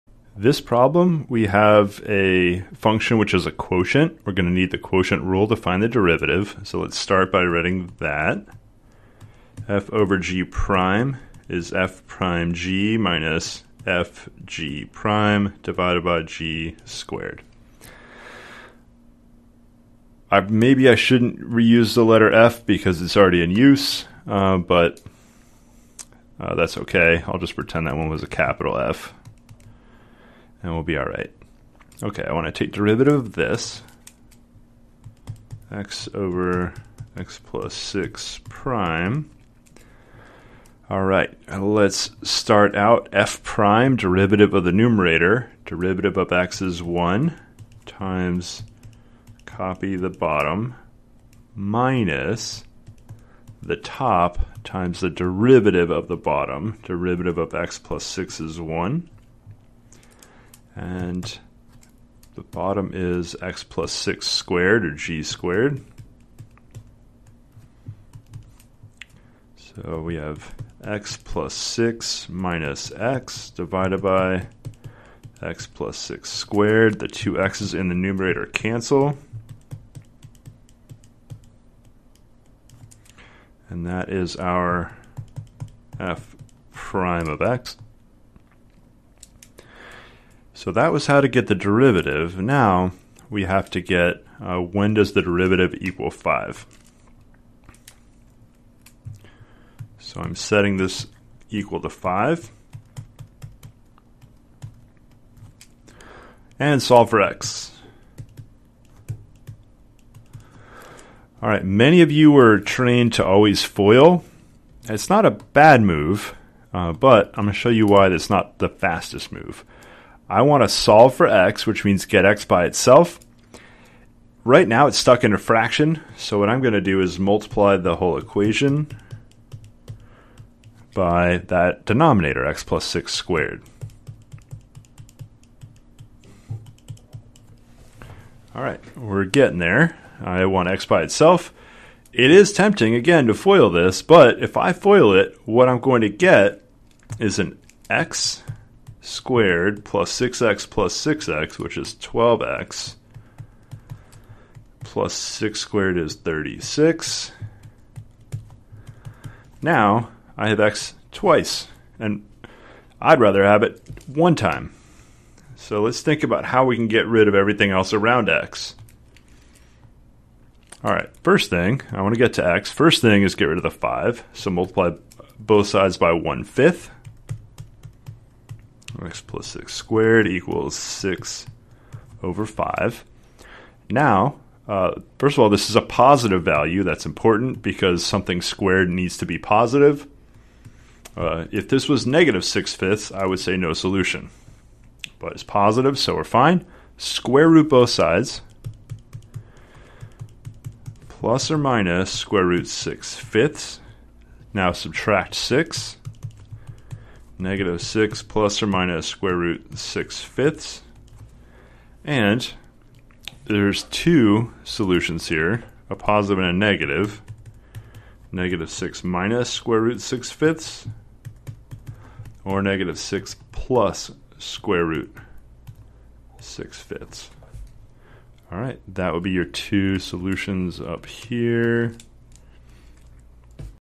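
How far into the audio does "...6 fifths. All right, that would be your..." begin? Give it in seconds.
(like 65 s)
226 s.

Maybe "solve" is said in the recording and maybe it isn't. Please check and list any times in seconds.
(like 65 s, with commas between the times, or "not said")
106 s, 120 s.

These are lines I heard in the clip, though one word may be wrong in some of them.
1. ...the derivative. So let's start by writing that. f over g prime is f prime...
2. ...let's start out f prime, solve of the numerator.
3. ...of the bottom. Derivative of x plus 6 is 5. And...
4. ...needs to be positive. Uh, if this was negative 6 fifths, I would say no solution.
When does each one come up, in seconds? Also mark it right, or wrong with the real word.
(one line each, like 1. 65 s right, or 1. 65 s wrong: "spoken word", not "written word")
1. 5 s right
2. 41 s wrong: "derivative", not "solve"
3. 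55 s wrong: "1", not "5"
4. 188 s right.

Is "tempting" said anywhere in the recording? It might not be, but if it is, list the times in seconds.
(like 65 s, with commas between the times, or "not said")
142 s.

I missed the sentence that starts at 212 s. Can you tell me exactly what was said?
And there's two solutions here, a positive and a negative.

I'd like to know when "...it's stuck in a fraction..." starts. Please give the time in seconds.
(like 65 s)
124 s.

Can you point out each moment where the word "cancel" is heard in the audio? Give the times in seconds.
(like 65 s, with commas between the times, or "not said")
78 s.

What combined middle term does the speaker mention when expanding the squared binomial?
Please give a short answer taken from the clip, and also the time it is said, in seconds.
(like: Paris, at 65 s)
12x, at 151 s.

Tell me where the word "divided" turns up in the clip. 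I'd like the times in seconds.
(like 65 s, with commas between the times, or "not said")
15 s, 73 s.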